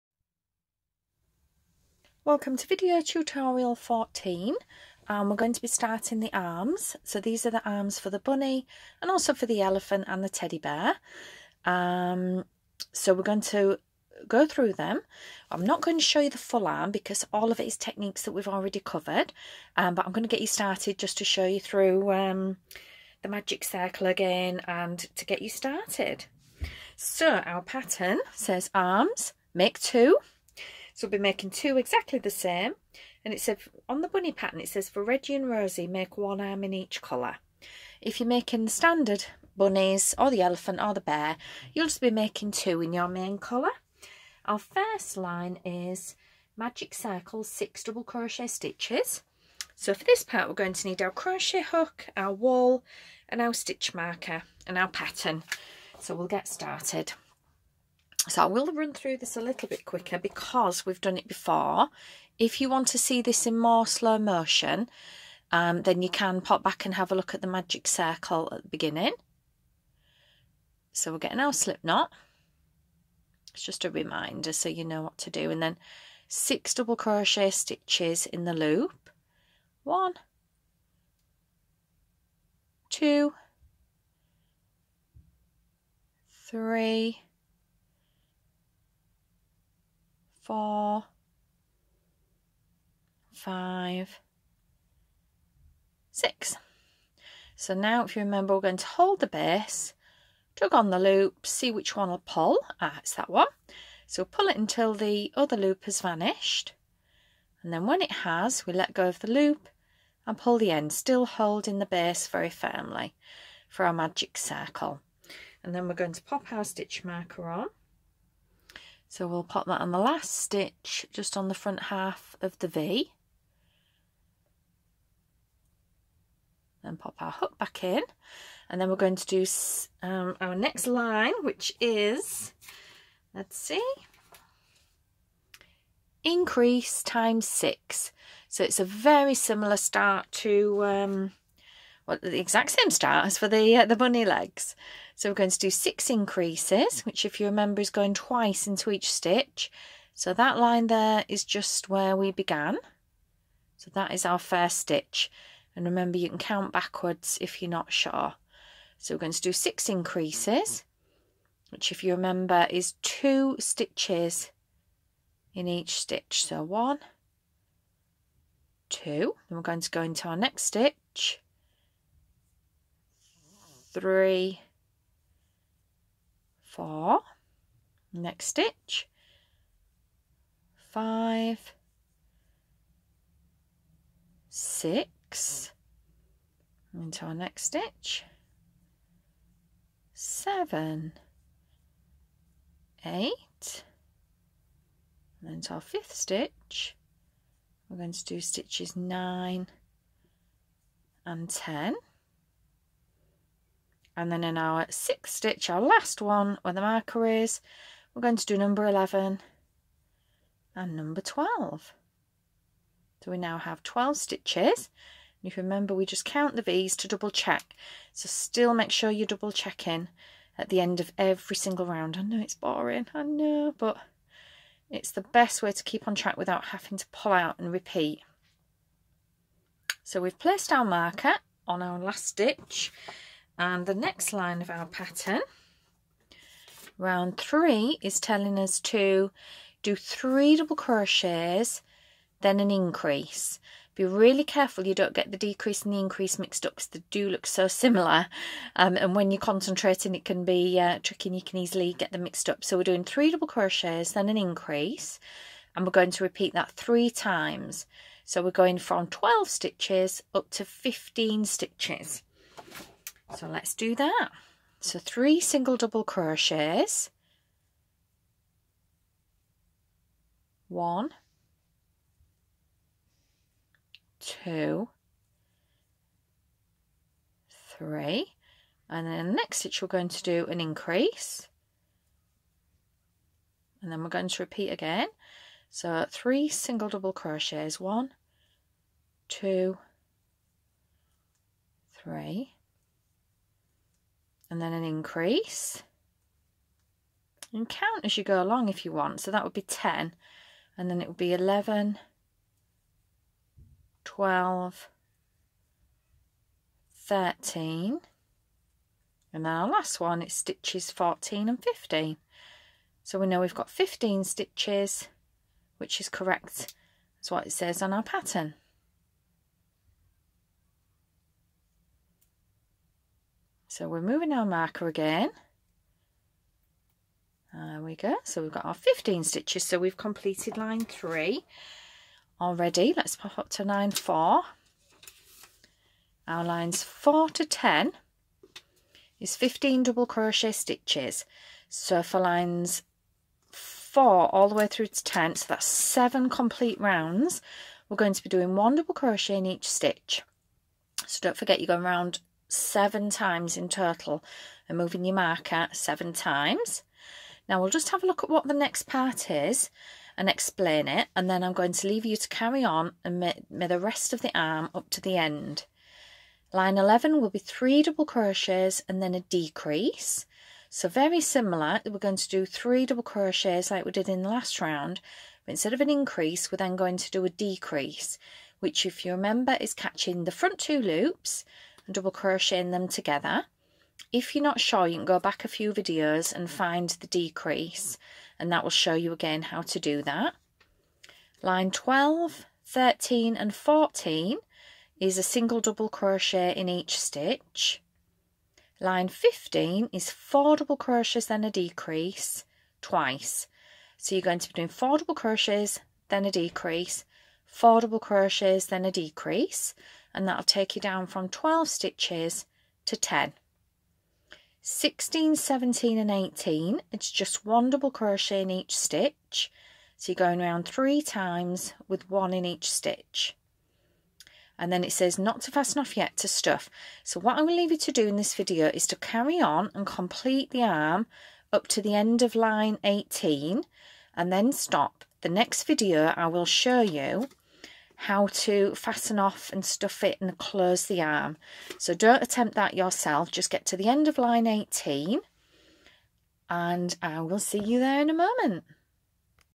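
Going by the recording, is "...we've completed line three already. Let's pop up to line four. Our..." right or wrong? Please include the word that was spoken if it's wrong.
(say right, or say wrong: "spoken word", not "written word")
right.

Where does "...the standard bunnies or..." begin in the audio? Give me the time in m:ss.
0:38.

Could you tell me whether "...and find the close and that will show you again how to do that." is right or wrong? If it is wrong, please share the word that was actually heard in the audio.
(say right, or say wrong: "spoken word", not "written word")
wrong: "decrease", not "close".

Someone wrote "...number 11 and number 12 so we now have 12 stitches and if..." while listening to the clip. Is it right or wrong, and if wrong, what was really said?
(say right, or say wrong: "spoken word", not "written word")
right.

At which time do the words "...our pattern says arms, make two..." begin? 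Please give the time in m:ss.
0:27.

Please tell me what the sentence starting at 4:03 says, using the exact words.
Be really careful you don't get the decrease and the increase mixed up because they do look so similar.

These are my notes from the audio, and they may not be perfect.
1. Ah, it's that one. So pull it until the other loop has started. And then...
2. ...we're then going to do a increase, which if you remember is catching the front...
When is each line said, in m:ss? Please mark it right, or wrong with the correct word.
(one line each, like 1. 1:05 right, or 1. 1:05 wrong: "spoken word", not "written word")
1. 1:42 wrong: "vanished", not "started"
2. 6:16 wrong: "decrease", not "increase".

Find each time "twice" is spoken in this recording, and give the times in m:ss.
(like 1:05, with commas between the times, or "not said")
2:28, 6:42.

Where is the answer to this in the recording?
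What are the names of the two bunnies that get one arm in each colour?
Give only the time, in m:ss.
0:35.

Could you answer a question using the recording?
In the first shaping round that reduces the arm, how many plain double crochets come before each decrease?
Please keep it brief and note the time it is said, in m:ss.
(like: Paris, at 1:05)
3, at 6:07.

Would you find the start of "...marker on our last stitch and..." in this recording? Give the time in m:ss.
3:50.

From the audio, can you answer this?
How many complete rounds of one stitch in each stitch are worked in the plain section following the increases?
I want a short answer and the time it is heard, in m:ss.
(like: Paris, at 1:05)
7, at 5:45.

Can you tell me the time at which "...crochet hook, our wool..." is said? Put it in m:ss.
0:51.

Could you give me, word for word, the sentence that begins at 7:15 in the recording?
The next video I will show you how to fasten off and stuff it and close the arm.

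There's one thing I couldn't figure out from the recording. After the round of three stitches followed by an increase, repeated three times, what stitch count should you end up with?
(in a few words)
15.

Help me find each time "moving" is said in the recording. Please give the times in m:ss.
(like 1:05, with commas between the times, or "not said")
5:24, 5:54.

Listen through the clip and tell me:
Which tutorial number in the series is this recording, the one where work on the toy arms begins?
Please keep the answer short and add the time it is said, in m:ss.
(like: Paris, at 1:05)
14, at 0:02.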